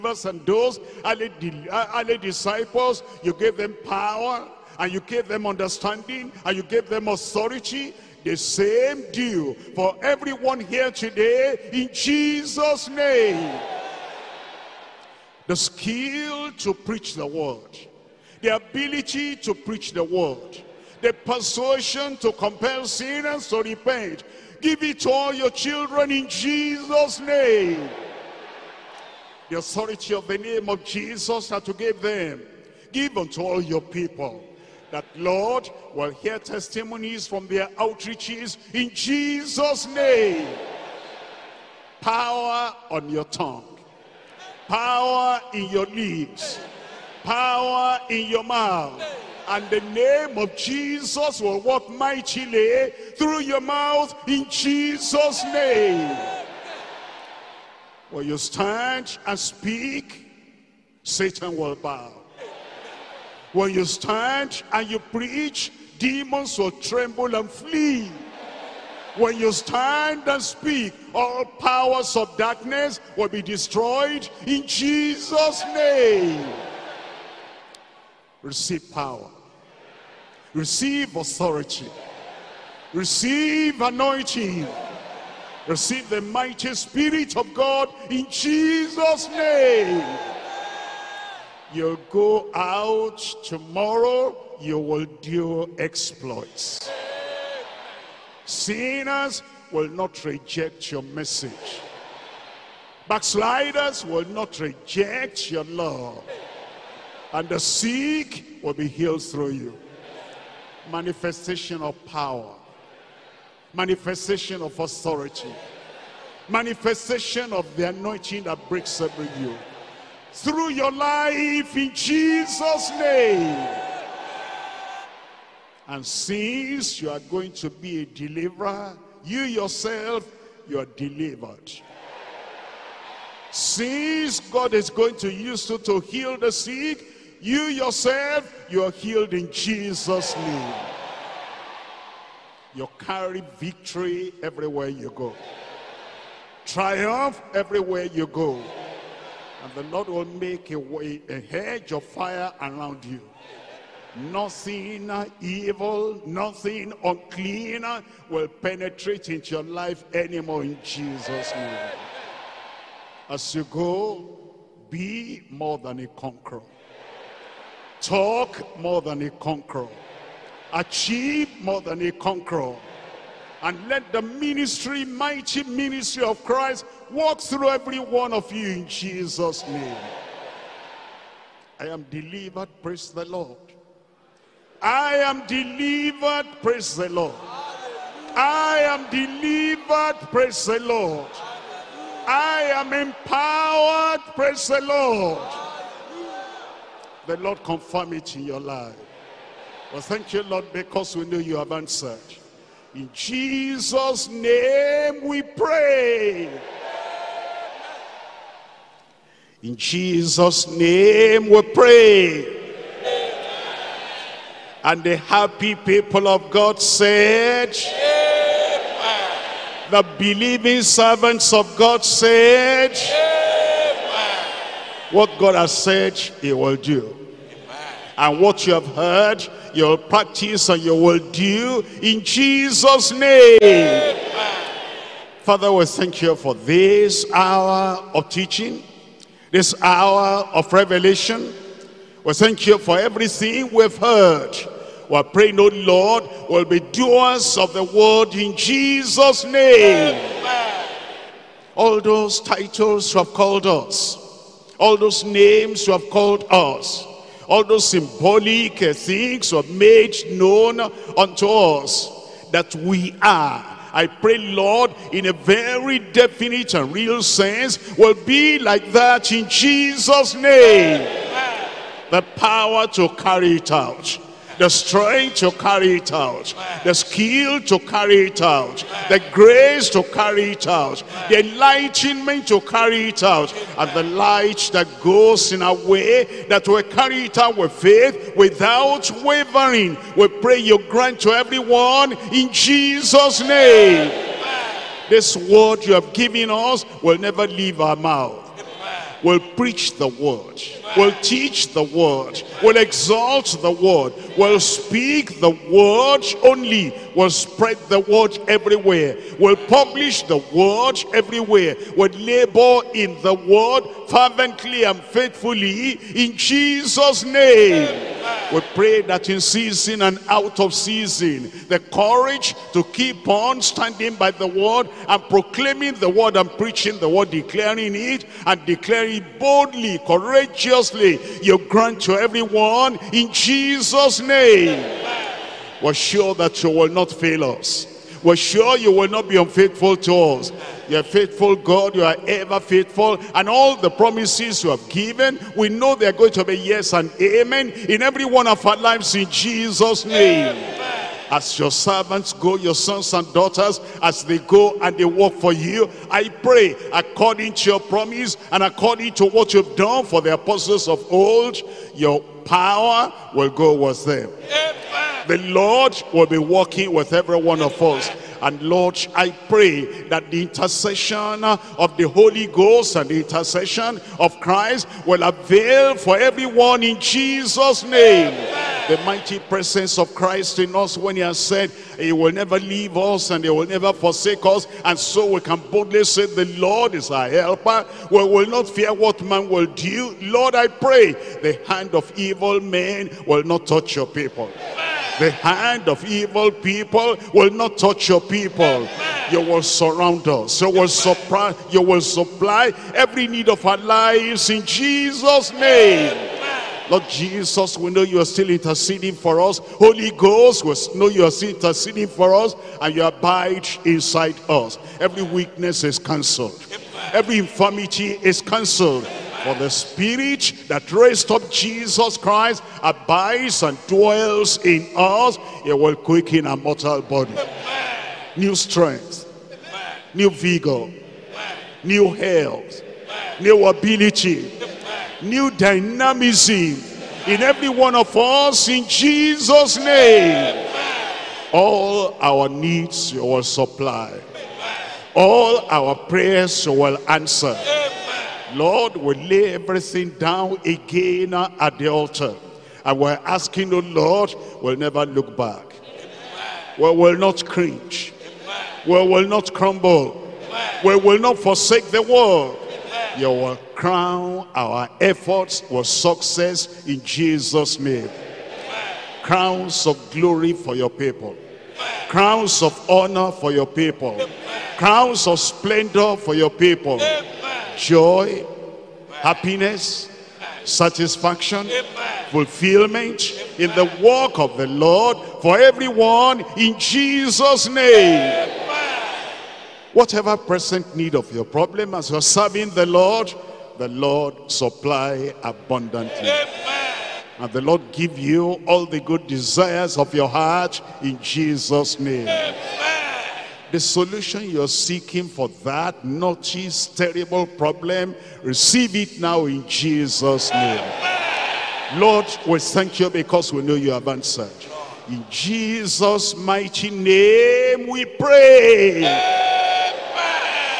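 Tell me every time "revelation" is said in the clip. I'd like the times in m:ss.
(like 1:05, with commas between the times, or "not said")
4:00.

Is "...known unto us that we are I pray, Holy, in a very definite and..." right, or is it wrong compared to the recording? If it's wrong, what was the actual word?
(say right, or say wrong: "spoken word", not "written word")
wrong: "Lord", not "Holy".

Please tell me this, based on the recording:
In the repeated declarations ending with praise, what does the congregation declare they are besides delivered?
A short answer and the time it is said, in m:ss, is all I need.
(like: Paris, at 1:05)
Empowered, at 3:12.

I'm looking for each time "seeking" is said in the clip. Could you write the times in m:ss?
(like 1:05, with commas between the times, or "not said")
8:24.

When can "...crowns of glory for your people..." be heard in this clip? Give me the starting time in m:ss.
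7:49.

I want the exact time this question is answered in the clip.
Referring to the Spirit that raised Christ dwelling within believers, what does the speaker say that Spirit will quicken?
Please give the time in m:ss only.
7:06.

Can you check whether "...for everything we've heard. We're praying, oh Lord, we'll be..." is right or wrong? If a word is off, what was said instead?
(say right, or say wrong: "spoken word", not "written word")
right.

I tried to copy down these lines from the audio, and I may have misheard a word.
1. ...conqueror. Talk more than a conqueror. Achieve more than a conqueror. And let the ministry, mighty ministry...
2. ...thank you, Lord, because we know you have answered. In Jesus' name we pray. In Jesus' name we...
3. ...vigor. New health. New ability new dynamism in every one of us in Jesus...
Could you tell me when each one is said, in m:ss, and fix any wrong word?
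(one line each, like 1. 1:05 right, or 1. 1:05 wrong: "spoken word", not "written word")
1. 2:46 right
2. 3:20 right
3. 7:10 right.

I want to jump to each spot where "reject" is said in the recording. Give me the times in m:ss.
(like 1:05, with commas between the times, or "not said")
1:40, 1:44.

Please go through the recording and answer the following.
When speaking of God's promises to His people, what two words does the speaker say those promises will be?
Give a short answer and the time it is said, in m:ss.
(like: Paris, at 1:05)
Yes and amen, at 5:46.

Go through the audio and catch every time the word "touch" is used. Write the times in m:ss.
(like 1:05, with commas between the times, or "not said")
6:33, 6:37.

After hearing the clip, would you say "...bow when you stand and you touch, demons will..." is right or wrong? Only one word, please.
wrong.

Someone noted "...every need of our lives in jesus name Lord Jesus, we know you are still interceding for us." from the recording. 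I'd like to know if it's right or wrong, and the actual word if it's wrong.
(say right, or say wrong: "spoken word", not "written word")
right.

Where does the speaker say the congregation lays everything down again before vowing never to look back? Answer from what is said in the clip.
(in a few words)
The altar.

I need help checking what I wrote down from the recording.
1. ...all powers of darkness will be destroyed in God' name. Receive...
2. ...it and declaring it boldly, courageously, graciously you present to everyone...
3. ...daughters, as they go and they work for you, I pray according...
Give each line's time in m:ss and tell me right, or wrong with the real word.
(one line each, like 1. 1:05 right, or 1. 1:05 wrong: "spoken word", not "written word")
1. 1:11 wrong: "Jesus", not "God"
2. 5:27 wrong: "grant", not "present"
3. 5:53 right.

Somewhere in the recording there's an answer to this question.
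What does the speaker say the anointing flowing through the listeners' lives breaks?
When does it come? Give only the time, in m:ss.
1:58.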